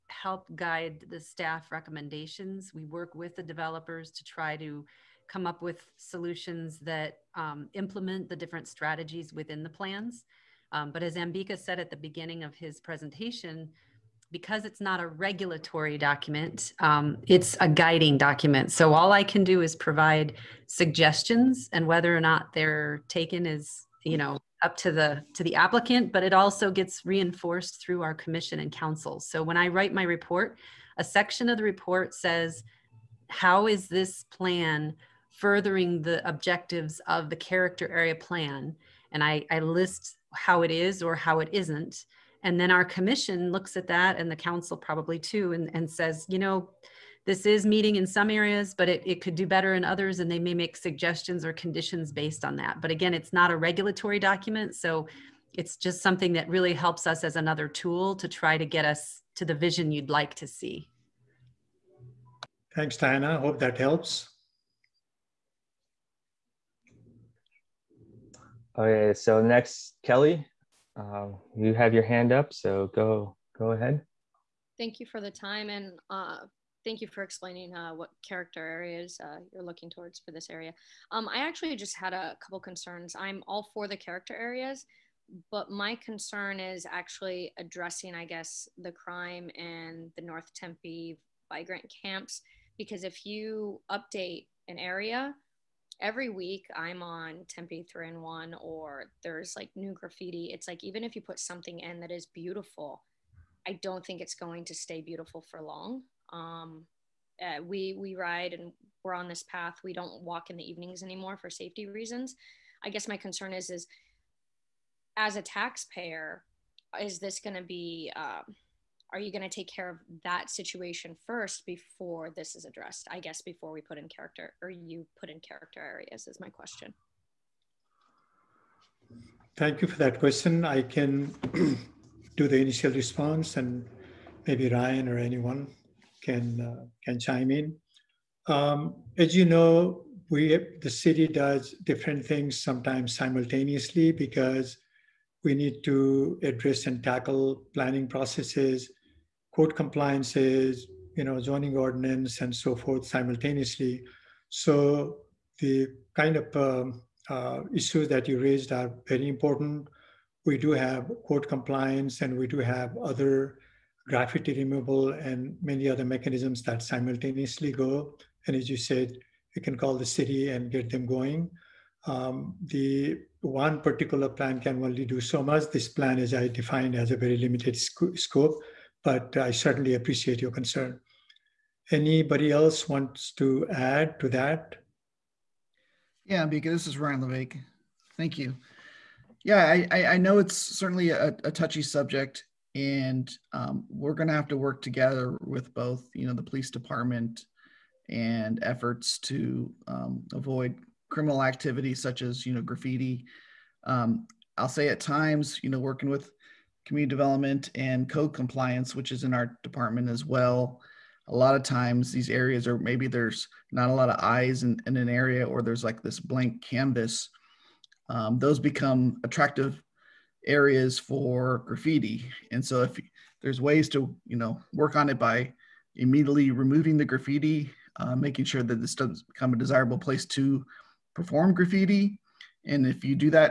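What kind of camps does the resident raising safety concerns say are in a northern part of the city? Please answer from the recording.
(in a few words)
Migrant camps.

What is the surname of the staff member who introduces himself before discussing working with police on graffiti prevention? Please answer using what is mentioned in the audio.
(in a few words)
Levesque.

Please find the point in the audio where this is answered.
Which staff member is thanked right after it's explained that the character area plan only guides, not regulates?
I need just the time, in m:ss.
1:02.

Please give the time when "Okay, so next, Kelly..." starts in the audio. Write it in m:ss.
1:08.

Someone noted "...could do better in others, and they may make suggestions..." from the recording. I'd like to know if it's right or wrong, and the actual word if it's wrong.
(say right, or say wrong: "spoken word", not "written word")
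right.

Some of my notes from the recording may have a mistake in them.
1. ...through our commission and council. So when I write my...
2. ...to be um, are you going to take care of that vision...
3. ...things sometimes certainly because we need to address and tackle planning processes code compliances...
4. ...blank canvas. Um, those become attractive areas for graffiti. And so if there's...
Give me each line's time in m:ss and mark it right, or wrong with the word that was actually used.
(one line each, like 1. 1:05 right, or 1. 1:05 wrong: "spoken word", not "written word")
1. 0:27 right
2. 1:57 wrong: "situation", not "vision"
3. 2:22 wrong: "simultaneously", not "certainly"
4. 3:36 right.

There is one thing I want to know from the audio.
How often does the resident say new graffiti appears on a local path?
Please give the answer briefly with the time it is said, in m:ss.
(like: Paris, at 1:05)
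Every week, at 1:36.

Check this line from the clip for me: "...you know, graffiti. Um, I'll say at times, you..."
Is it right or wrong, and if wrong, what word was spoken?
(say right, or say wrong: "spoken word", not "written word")
right.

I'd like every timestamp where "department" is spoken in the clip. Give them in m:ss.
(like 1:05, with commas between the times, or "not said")
3:16, 3:29.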